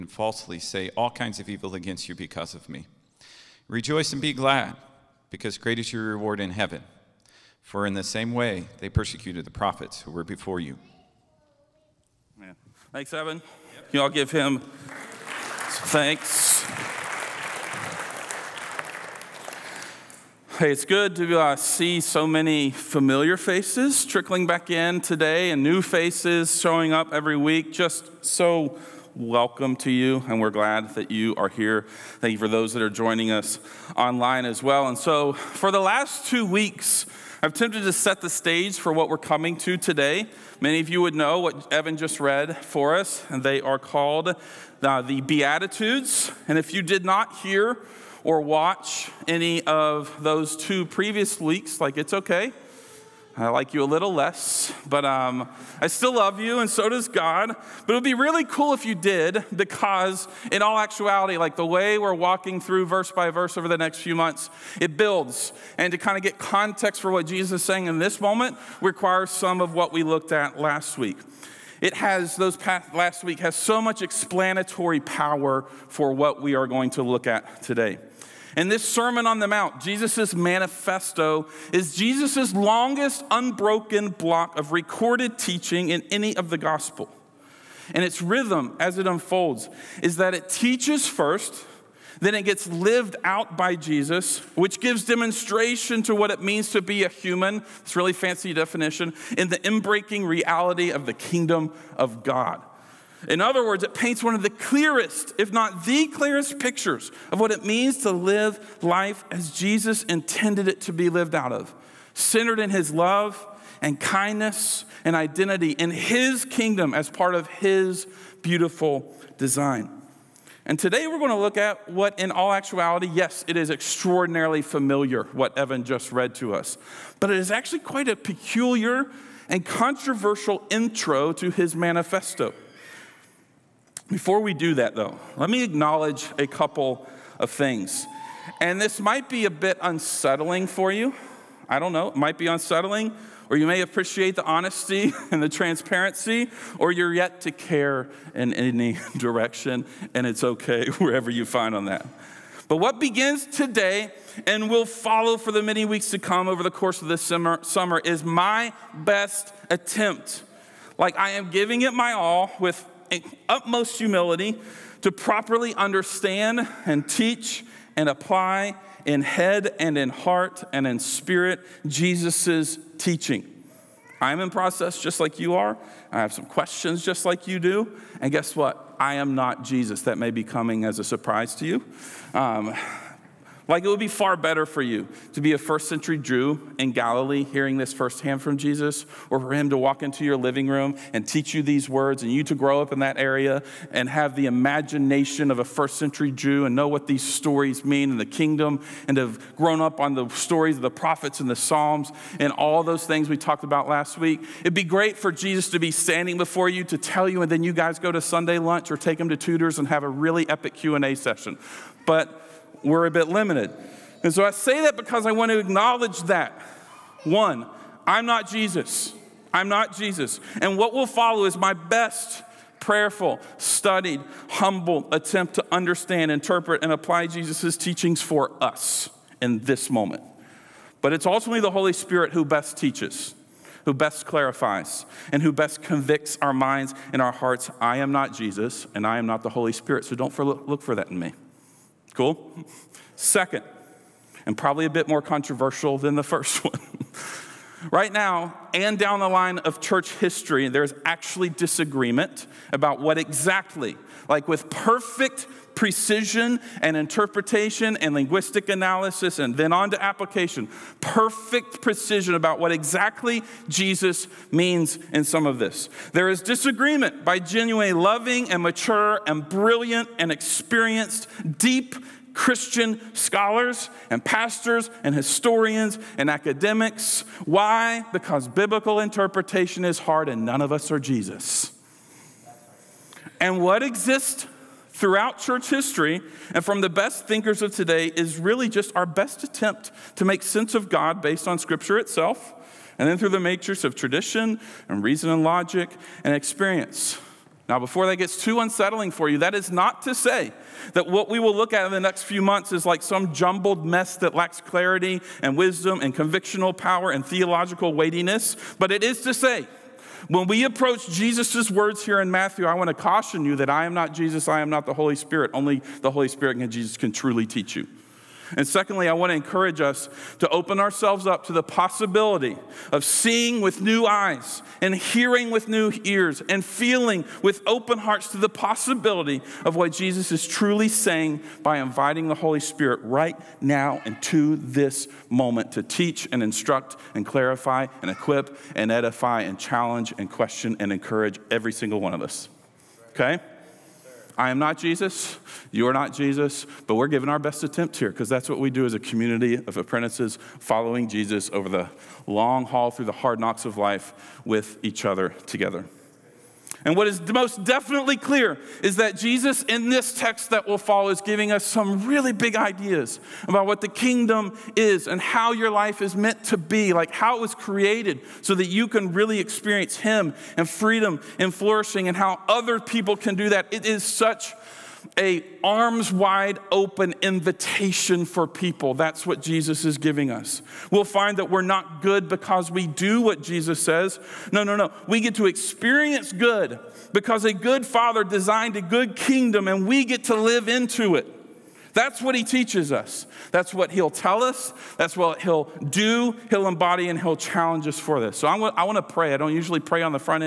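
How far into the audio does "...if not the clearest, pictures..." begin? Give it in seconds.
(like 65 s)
105 s.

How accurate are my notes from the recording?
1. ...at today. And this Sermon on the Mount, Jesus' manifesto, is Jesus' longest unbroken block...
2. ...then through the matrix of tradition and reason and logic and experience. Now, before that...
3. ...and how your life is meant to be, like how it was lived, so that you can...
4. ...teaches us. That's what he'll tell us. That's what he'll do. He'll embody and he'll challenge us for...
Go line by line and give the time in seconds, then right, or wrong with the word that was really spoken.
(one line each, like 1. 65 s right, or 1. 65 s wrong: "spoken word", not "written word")
1. 77 s right
2. 293 s right
3. 365 s wrong: "created", not "lived"
4. 392 s right.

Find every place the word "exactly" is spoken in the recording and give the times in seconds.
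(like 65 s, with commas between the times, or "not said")
253 s, 262 s.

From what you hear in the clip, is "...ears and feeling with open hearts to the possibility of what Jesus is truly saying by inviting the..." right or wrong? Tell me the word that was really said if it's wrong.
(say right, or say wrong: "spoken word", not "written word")
right.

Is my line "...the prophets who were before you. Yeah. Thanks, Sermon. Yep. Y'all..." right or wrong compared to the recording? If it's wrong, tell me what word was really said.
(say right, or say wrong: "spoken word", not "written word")
wrong: "Evan", not "Sermon".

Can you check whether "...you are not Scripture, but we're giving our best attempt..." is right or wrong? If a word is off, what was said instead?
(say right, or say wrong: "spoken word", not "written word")
wrong: "Jesus", not "Scripture".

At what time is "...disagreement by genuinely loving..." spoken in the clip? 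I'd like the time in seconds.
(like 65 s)
266 s.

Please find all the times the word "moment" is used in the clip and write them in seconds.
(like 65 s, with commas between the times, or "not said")
68 s, 229 s, 335 s.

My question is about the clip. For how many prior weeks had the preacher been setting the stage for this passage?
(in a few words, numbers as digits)
2.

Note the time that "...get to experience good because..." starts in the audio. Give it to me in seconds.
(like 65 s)
385 s.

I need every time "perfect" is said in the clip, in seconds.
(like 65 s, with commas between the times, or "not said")
254 s, 261 s.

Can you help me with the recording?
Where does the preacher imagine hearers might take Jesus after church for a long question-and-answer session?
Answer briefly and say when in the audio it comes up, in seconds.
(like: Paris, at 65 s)
Tutors, at 208 s.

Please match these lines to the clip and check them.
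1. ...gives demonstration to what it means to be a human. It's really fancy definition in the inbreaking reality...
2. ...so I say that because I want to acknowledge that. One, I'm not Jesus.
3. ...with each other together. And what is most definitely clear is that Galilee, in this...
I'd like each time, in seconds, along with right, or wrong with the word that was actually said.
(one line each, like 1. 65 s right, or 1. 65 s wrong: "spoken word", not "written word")
1. 94 s right
2. 214 s right
3. 354 s wrong: "Jesus", not "Galilee".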